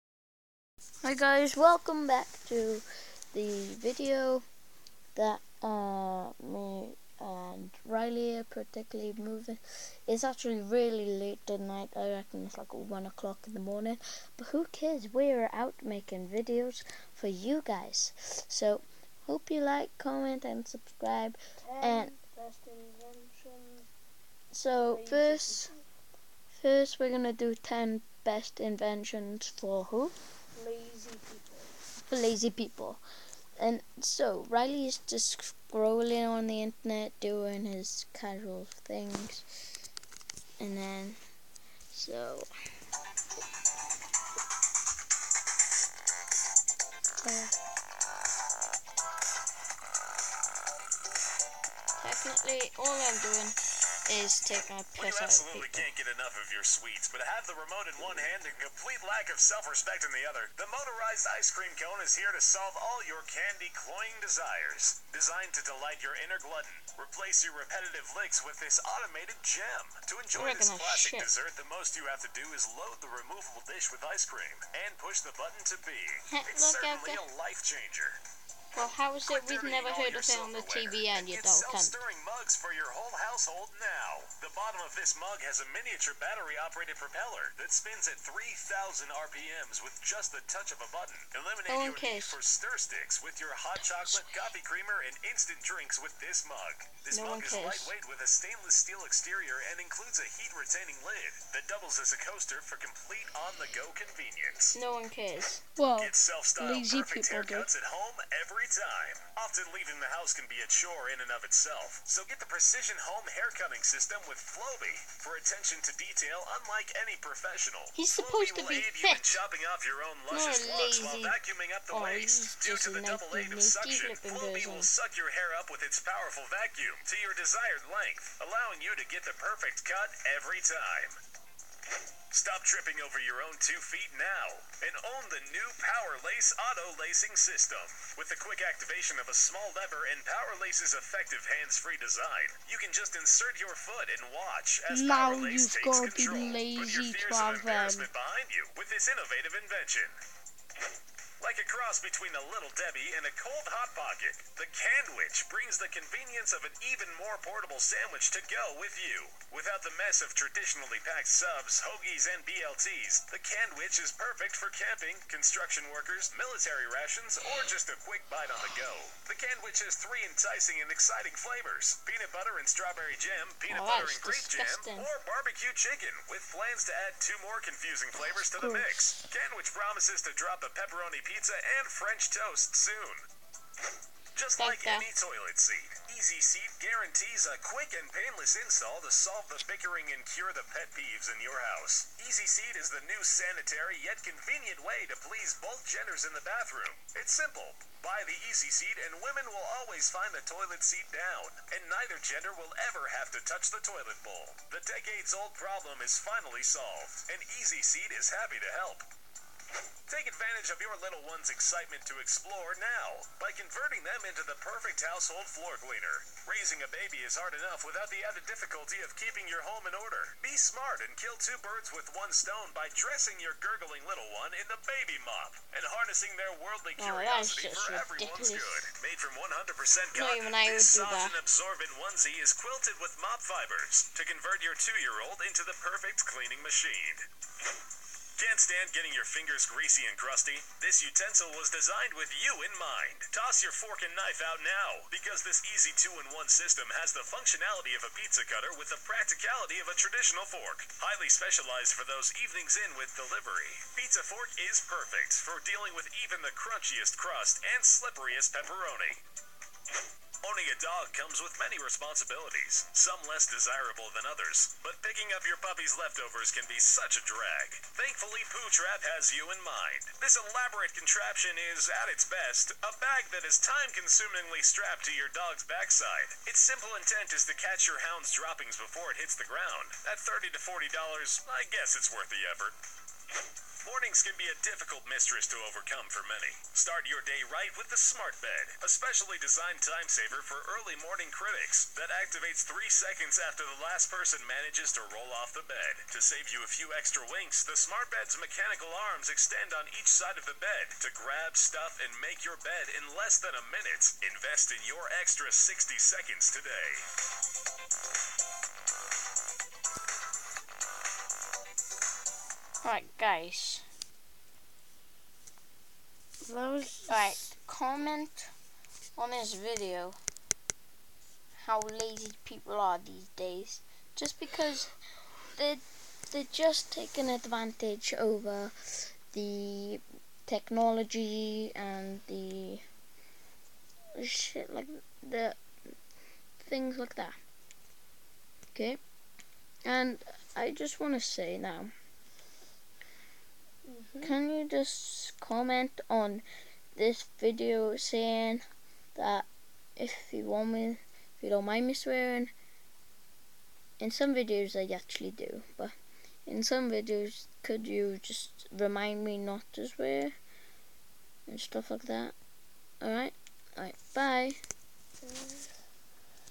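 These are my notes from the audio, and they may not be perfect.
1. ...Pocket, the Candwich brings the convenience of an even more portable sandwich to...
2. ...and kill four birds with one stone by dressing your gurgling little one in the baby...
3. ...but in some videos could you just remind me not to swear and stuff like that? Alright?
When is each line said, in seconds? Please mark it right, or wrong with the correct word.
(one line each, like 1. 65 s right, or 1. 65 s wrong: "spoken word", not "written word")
1. 153 s right
2. 220 s wrong: "two", not "four"
3. 355 s right.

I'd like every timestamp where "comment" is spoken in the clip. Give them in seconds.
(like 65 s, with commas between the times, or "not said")
19 s, 317 s, 345 s.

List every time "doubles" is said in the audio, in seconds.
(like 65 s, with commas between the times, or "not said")
101 s, 123 s.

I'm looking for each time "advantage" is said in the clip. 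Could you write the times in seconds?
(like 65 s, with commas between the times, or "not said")
210 s, 327 s.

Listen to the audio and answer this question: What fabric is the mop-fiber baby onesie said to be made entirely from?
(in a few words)
Cotton.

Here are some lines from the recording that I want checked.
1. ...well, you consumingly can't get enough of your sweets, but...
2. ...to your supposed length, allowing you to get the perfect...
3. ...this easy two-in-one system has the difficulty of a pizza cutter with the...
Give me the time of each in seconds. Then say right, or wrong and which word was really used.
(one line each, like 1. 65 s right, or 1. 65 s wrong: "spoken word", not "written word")
1. 54 s wrong: "absolutely", not "consumingly"
2. 127 s wrong: "desired", not "supposed"
3. 245 s wrong: "functionality", not "difficulty".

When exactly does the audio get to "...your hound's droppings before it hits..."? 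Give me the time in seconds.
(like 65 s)
277 s.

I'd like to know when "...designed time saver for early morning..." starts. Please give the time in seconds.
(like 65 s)
289 s.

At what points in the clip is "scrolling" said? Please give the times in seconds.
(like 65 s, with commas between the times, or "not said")
35 s.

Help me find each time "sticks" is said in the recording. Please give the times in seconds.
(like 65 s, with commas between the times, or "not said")
92 s.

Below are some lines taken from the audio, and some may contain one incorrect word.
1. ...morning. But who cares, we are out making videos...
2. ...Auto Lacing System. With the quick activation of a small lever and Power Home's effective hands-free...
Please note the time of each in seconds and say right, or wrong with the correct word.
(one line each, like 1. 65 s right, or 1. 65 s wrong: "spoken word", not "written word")
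1. 13 s right
2. 136 s wrong: "Lace", not "Home".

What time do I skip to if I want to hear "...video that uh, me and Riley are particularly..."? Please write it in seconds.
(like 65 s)
3 s.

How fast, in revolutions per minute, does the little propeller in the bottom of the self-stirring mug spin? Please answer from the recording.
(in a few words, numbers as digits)
3,000 RPM.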